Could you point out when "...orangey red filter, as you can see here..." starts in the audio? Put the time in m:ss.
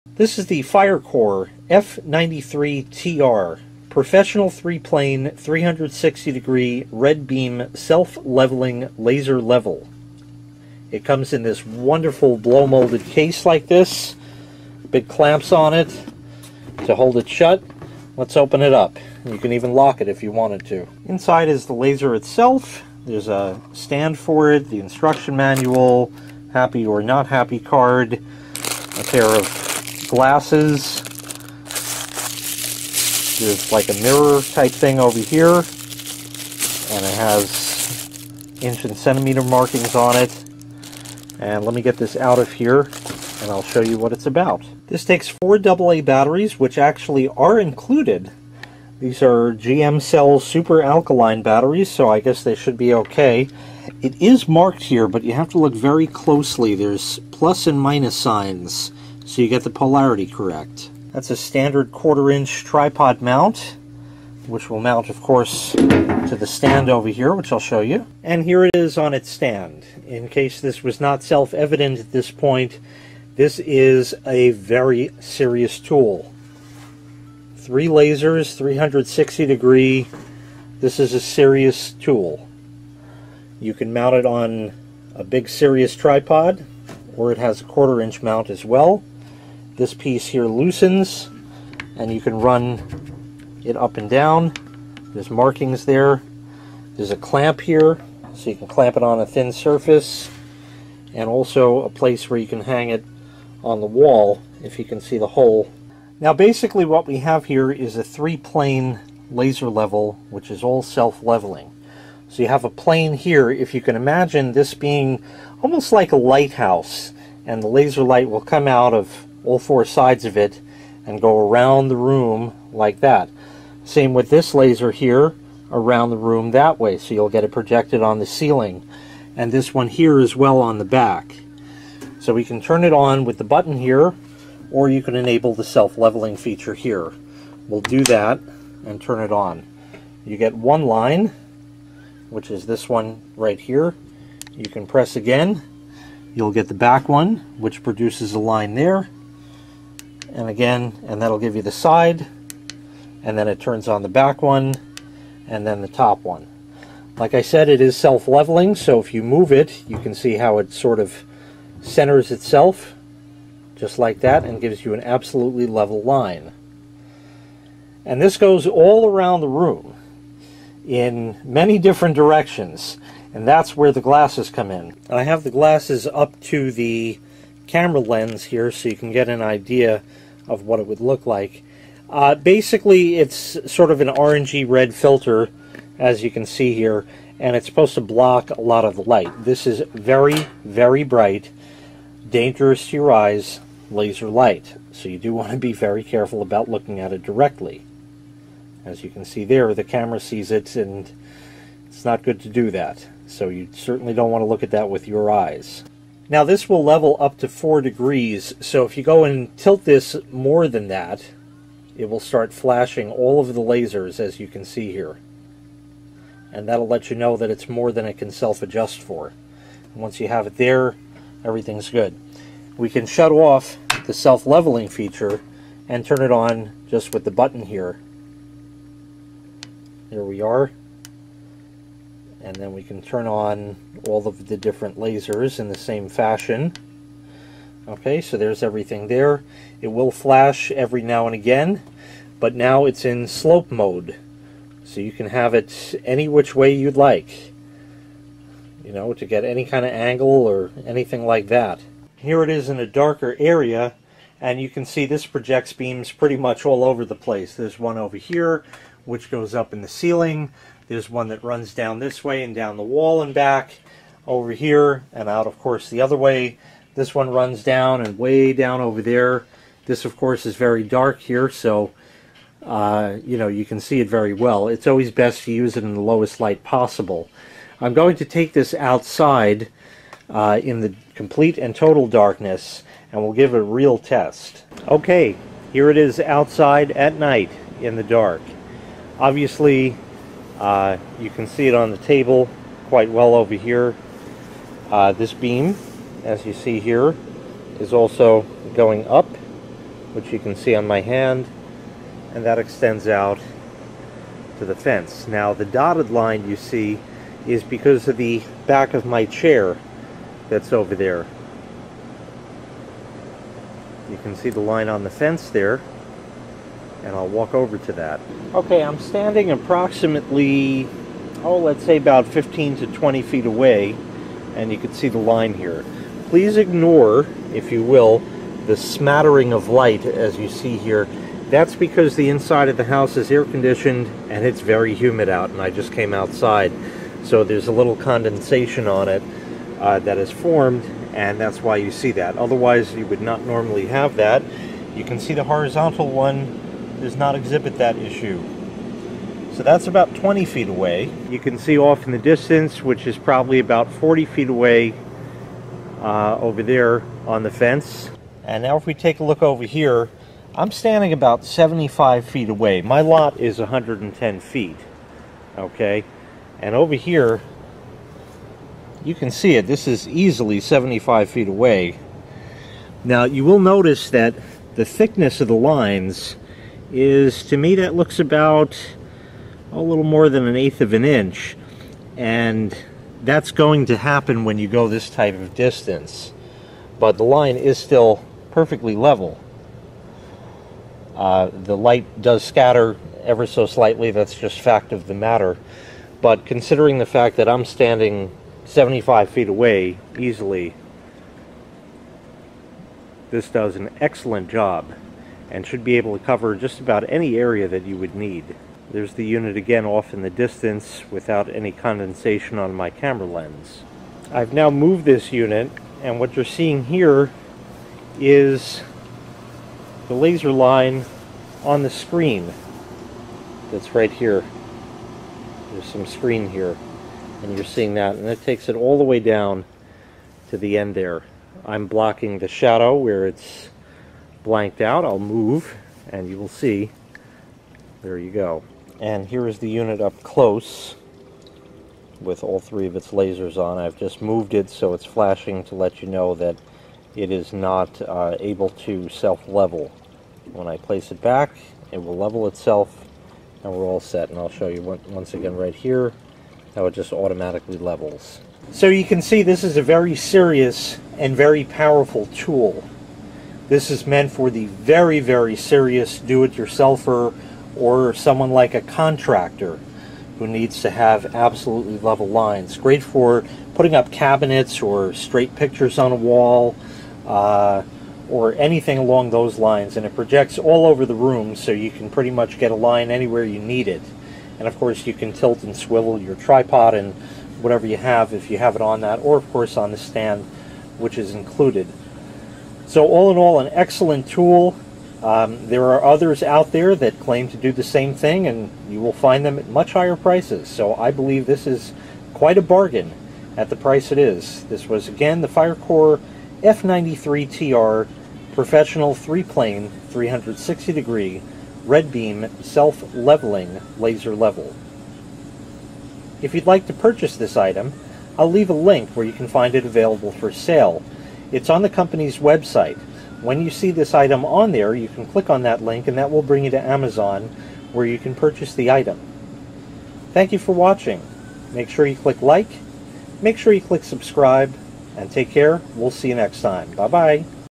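3:04.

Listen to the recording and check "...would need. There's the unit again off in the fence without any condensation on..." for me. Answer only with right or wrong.
wrong.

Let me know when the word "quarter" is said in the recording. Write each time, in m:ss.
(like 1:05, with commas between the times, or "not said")
1:01, 1:27.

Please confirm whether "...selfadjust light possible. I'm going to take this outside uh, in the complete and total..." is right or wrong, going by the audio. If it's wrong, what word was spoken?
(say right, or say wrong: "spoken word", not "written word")
wrong: "lowest", not "selfadjust".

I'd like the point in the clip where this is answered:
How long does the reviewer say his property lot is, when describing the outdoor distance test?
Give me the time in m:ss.
6:03.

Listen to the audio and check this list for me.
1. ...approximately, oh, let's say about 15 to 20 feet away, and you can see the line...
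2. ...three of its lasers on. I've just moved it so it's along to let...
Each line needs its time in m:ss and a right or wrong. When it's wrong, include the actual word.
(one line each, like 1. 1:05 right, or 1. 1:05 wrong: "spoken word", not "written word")
1. 5:19 right
2. 7:22 wrong: "flashing", not "along".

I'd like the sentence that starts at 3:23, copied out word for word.
So you certainly don't want to look at that with your eyes.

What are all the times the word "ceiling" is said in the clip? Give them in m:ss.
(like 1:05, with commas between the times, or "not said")
2:08, 4:19.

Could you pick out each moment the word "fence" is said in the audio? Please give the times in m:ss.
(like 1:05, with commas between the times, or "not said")
5:04, 5:15, 5:57.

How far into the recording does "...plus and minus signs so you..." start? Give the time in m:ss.
0:57.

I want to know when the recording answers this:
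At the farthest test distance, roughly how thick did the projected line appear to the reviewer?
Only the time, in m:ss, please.
6:19.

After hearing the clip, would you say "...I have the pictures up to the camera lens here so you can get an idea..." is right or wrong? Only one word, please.
wrong.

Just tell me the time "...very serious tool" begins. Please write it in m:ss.
1:14.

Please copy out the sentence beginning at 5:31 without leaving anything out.
That's because the inside of the house is air conditioned and it's very humid out, and I just came outside.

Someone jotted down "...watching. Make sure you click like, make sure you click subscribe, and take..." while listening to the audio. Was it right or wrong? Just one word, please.
right.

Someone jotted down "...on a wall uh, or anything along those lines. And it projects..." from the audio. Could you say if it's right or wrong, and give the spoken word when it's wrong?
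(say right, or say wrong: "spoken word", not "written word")
right.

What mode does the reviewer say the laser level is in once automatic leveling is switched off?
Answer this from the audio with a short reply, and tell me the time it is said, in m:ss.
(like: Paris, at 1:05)
slope mode, at 4:03.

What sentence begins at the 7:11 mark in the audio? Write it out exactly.
I'm blocking the shadow where it's blanked out.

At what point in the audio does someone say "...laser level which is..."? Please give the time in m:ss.
1:49.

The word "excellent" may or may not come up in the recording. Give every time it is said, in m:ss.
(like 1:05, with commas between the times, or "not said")
6:44, 8:13.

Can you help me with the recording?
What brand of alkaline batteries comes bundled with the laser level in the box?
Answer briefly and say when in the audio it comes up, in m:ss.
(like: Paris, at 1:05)
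GM Cell, at 0:49.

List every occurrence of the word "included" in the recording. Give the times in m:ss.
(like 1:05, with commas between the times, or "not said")
0:47, 8:11.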